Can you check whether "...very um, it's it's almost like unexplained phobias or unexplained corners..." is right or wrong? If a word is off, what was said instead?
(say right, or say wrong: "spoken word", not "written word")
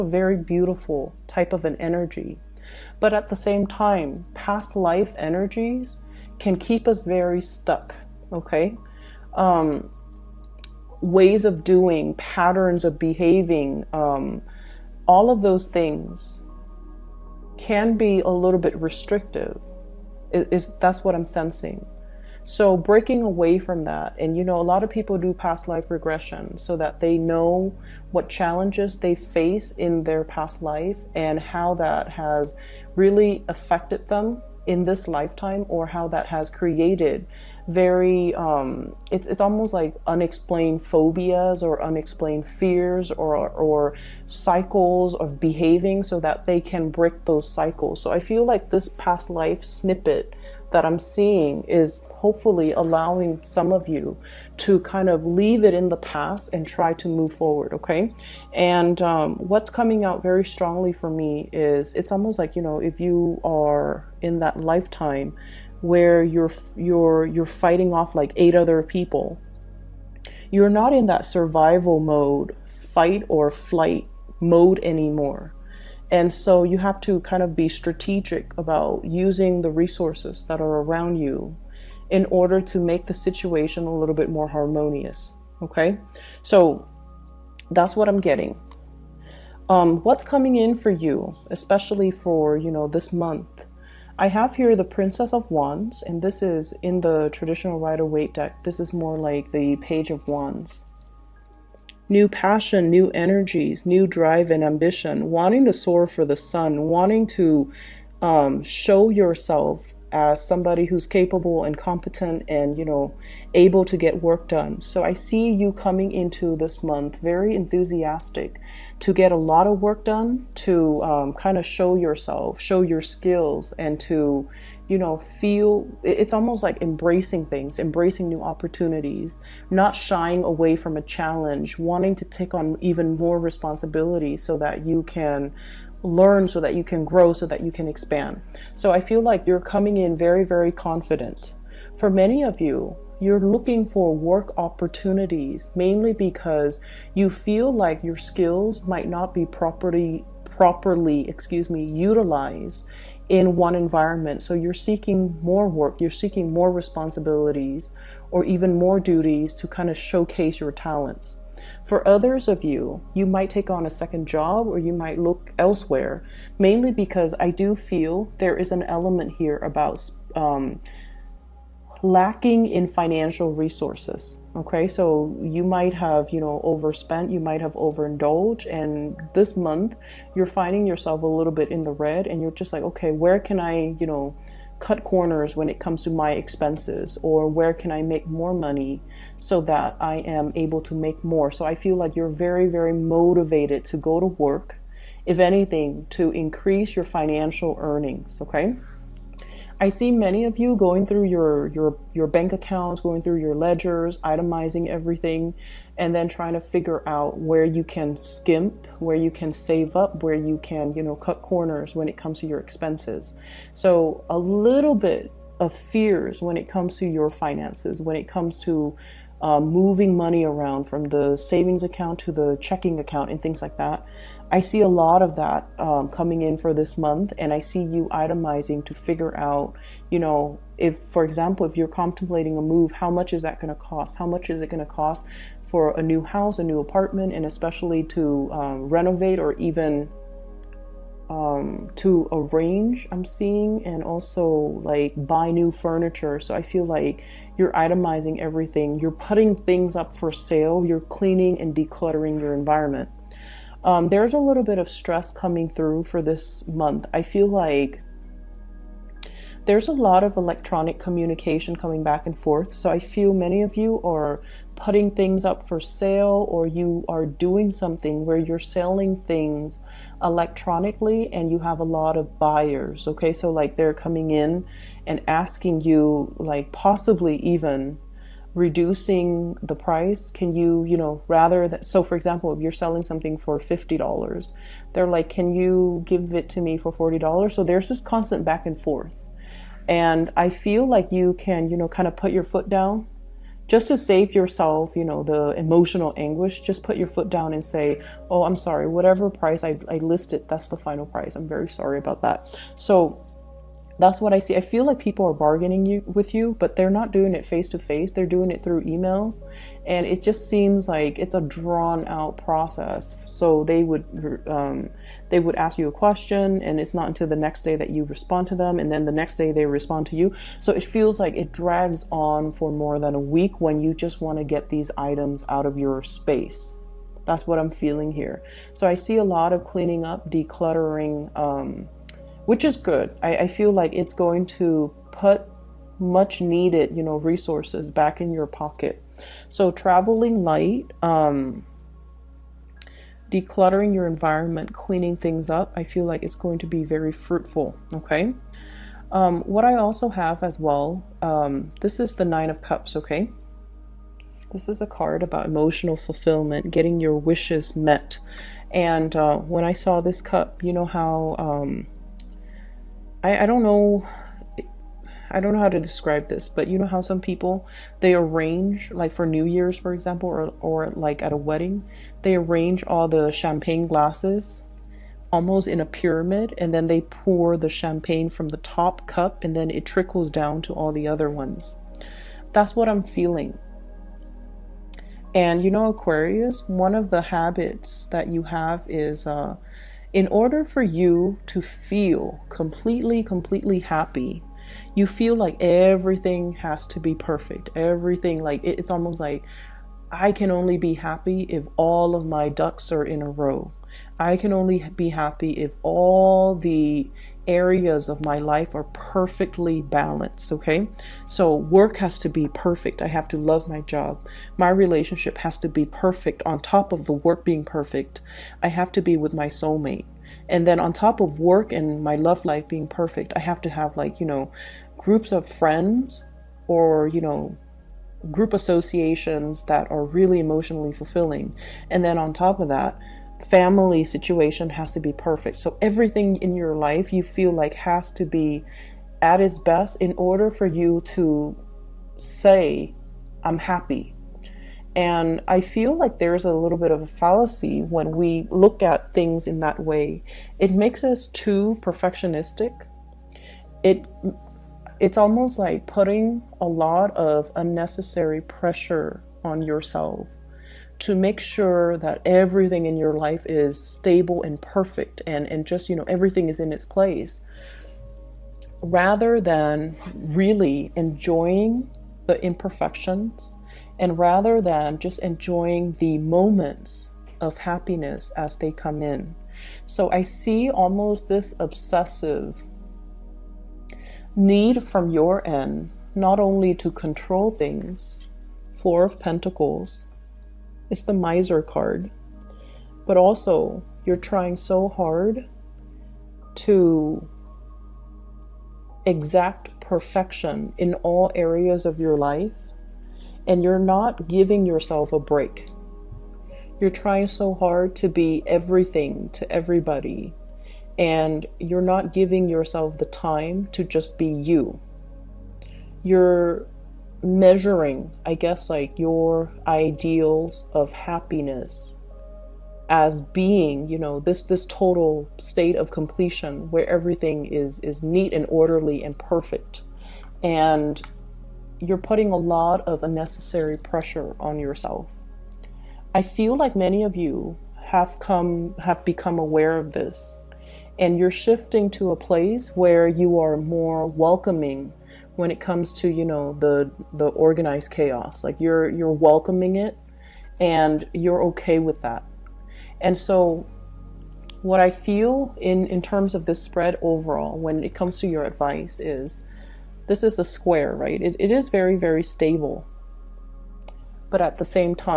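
wrong: "fears", not "corners".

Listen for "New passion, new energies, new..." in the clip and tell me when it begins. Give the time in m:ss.
1:42.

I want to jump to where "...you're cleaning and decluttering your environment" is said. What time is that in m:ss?
4:10.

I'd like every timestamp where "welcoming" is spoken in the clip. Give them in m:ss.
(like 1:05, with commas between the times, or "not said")
9:04, 9:09.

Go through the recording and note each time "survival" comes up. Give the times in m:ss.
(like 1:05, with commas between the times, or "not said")
1:11.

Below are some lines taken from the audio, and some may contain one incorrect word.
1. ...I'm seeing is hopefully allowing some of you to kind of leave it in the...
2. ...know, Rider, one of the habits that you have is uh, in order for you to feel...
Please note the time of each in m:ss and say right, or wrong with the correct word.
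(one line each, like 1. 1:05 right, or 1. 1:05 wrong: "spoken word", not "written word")
1. 0:50 right
2. 6:25 wrong: "Aquarius", not "Rider".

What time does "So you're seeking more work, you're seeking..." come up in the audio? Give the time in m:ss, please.
2:34.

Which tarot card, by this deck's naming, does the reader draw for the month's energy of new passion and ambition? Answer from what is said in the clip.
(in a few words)
Princess of Wands.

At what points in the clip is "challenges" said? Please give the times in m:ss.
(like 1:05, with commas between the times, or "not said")
0:28, 2:11.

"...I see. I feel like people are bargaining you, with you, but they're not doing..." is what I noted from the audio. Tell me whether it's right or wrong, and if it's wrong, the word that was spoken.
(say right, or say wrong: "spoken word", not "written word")
right.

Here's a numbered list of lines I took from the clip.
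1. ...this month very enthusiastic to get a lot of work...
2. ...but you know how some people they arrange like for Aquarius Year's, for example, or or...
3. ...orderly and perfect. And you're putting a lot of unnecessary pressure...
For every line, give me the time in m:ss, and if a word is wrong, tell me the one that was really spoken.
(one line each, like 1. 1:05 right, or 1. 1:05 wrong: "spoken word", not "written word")
1. 1:56 right
2. 6:06 wrong: "New", not "Aquarius"
3. 8:48 right.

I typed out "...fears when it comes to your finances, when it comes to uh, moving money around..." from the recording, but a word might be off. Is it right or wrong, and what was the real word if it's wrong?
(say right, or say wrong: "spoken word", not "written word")
right.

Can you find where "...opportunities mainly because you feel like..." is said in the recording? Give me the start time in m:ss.
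2:24.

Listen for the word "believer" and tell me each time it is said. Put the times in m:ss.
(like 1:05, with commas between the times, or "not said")
not said.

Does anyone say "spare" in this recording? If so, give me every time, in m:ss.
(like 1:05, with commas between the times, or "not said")
not said.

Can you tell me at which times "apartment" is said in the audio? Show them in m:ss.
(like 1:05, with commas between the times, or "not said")
3:56.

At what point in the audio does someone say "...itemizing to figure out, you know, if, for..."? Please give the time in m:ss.
3:48.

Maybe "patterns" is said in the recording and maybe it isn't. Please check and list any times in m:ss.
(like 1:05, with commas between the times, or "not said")
0:12.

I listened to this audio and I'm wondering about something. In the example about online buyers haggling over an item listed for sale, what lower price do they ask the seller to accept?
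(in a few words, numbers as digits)
$40.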